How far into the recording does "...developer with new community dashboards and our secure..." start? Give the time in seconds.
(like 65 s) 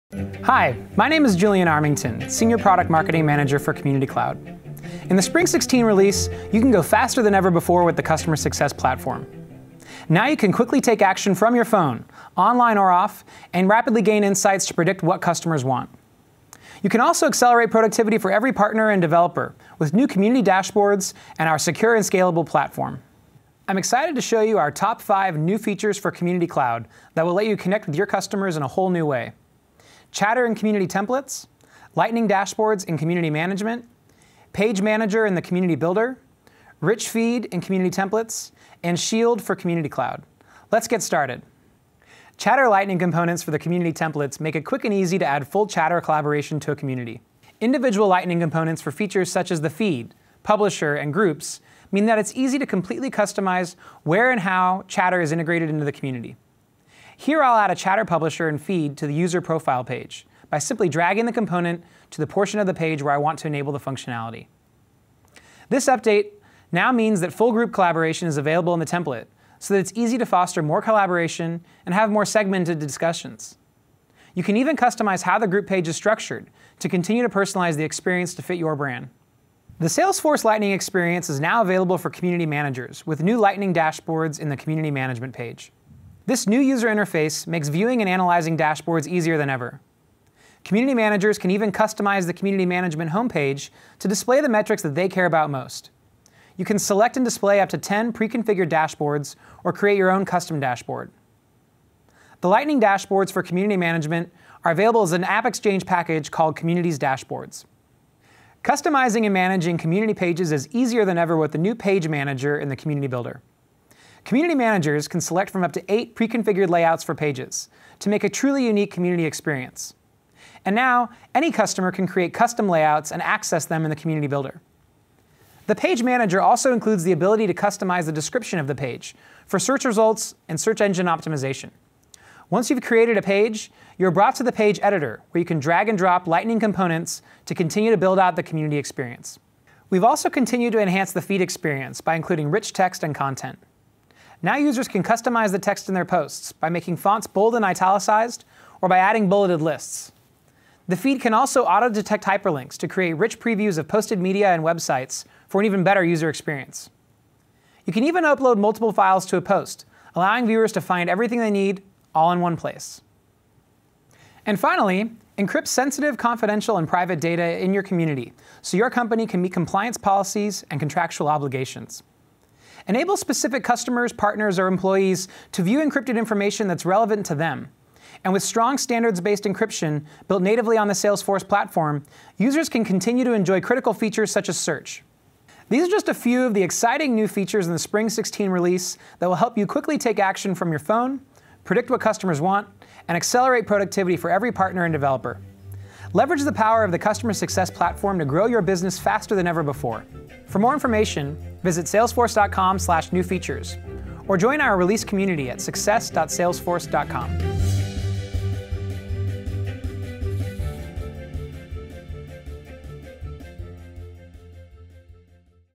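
19 s.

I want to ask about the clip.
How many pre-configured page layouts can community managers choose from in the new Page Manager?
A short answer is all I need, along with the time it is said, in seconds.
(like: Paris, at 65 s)
8, at 115 s.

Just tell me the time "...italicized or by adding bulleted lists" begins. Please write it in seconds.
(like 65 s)
147 s.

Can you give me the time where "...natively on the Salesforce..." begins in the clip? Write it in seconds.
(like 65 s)
180 s.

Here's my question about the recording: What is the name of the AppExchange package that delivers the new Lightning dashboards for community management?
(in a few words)
Communities Dashboards.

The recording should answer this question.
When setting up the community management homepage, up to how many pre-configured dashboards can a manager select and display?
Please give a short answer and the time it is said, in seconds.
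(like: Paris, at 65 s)
10, at 97 s.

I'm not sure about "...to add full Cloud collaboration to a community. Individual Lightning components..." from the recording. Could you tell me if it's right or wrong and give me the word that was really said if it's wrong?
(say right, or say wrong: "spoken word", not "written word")
wrong: "Chatter", not "Cloud".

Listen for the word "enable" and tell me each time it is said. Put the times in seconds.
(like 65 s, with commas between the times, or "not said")
63 s, 172 s.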